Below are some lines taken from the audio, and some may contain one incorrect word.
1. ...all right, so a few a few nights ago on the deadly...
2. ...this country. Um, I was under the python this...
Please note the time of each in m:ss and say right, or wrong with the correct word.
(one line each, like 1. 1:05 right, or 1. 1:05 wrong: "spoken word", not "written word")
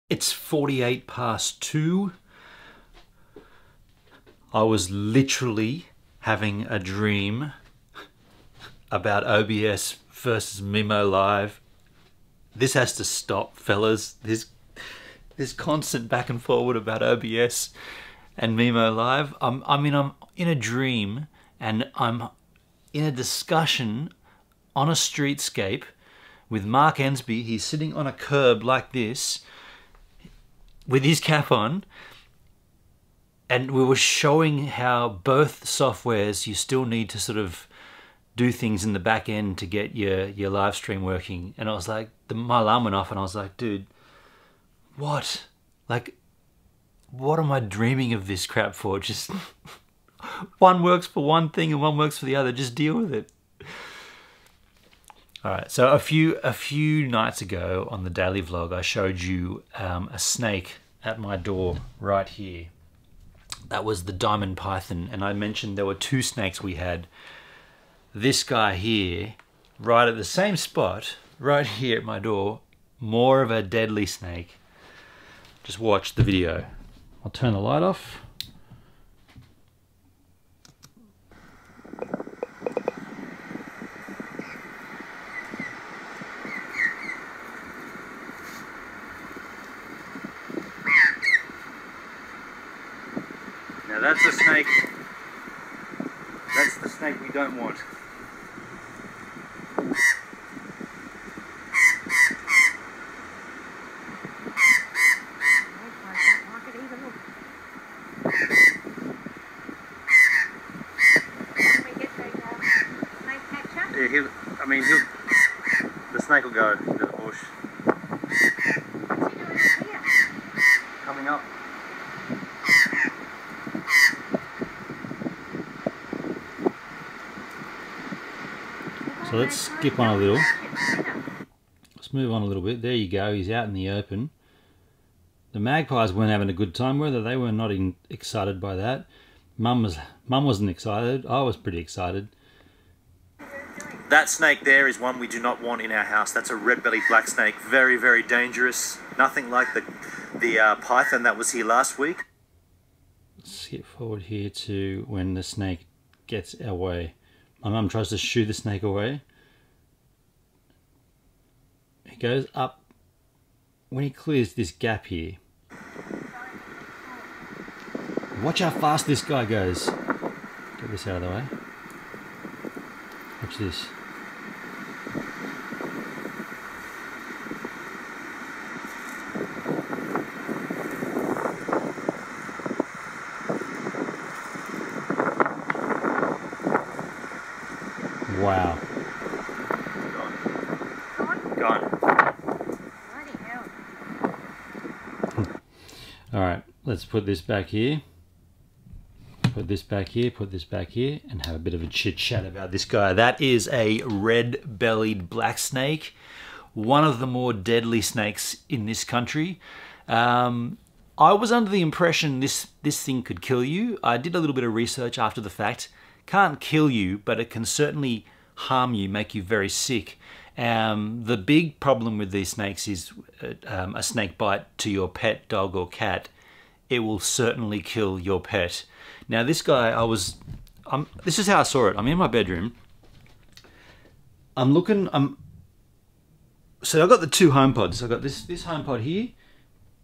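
1. 0:55 wrong: "daily", not "deadly"
2. 3:28 wrong: "impression", not "python".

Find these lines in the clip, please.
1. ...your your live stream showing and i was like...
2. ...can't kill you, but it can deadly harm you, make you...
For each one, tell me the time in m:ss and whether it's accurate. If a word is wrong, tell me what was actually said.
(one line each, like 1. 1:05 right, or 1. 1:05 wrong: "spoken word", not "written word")
1. 0:39 wrong: "working", not "showing"
2. 3:36 wrong: "certainly", not "deadly".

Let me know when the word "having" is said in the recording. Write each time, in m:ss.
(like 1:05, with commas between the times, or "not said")
0:06, 2:16.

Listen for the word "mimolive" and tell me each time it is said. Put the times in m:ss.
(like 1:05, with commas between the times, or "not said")
0:10, 0:18.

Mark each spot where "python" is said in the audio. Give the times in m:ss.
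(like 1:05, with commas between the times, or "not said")
1:04, 2:30.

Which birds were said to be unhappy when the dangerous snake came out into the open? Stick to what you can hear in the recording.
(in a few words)
magpies.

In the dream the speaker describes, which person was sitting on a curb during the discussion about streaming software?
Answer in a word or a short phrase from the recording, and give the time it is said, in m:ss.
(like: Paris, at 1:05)
Mark Ensby, at 0:26.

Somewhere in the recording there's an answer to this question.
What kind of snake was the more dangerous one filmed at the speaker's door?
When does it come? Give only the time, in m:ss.
2:26.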